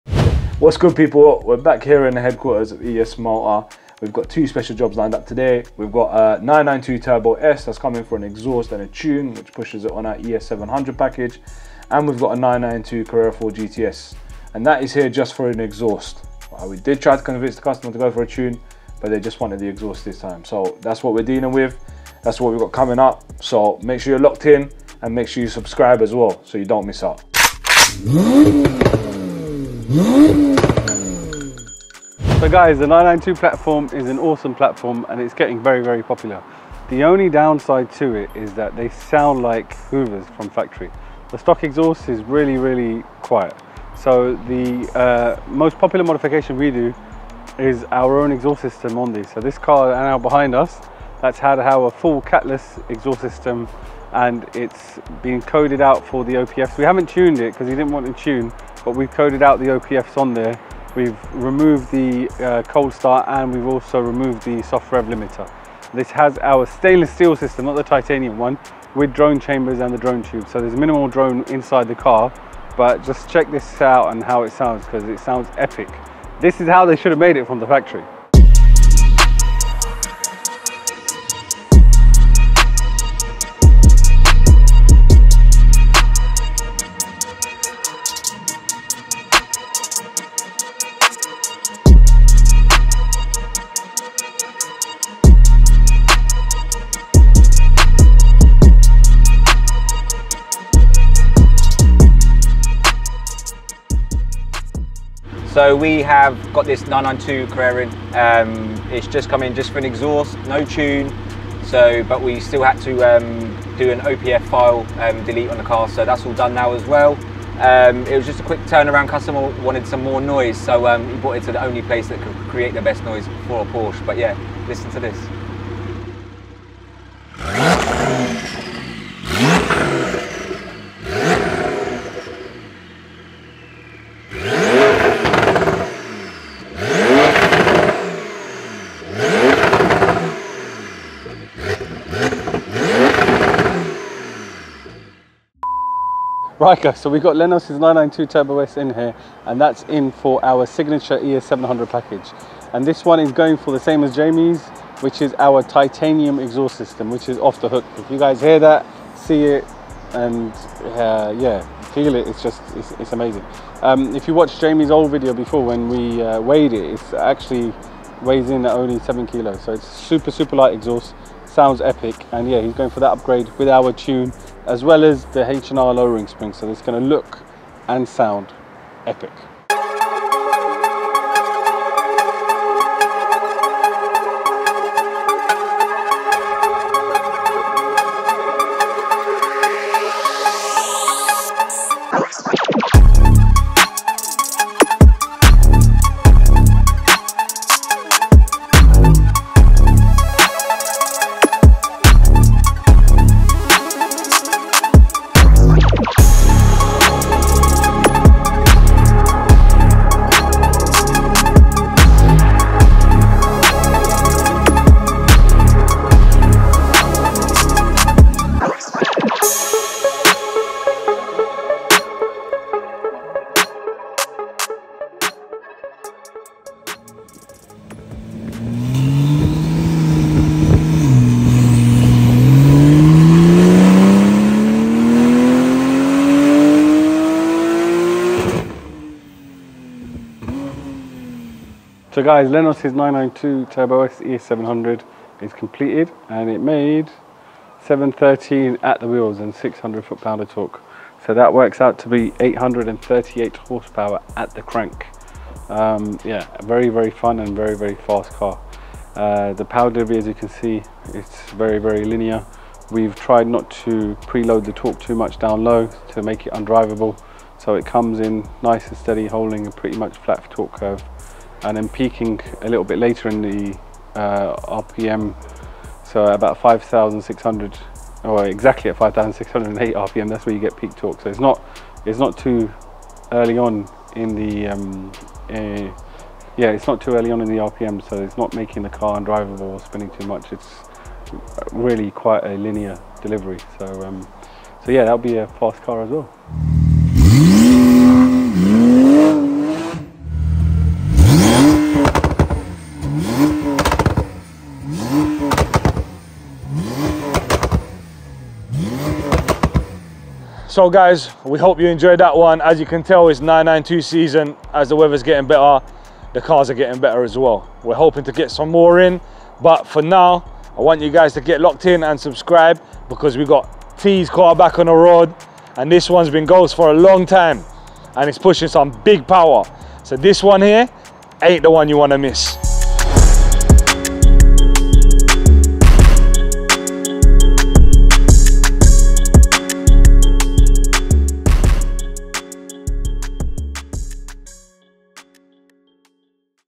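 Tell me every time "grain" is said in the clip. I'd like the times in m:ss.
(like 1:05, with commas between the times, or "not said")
not said.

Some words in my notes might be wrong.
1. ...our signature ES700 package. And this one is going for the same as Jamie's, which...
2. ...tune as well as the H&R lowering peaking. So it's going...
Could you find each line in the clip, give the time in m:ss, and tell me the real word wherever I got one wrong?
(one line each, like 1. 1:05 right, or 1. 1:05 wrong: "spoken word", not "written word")
1. 2:30 right
2. 2:53 wrong: "spring", not "peaking".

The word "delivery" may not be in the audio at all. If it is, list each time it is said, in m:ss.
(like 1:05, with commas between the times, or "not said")
4:19, 4:53.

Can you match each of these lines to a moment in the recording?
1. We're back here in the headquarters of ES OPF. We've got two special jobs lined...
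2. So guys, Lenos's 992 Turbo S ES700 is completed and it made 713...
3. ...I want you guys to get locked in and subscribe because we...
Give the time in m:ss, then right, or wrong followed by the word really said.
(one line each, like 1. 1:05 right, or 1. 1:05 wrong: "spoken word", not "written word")
1. 0:01 wrong: "Motor", not "OPF"
2. 4:02 right
3. 5:20 right.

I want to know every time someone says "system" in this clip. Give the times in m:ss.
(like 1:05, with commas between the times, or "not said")
0:48, 0:53, 1:07, 2:36.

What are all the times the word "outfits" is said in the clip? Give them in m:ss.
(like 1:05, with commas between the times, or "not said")
not said.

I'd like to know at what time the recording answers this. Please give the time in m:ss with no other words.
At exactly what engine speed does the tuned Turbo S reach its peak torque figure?
4:38.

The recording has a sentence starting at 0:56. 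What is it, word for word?
We haven't tuned it because he didn't want to tune, but we've coded out the OPFs on there.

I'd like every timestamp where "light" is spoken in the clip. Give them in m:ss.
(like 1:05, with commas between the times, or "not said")
2:50.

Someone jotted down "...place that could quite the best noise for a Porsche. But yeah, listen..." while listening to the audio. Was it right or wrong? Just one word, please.
wrong.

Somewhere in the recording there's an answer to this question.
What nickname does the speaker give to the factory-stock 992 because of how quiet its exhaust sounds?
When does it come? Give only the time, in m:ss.
0:39.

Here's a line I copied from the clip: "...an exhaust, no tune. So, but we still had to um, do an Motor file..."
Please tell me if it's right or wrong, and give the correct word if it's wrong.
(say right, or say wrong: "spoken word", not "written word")
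wrong: "OPF", not "Motor".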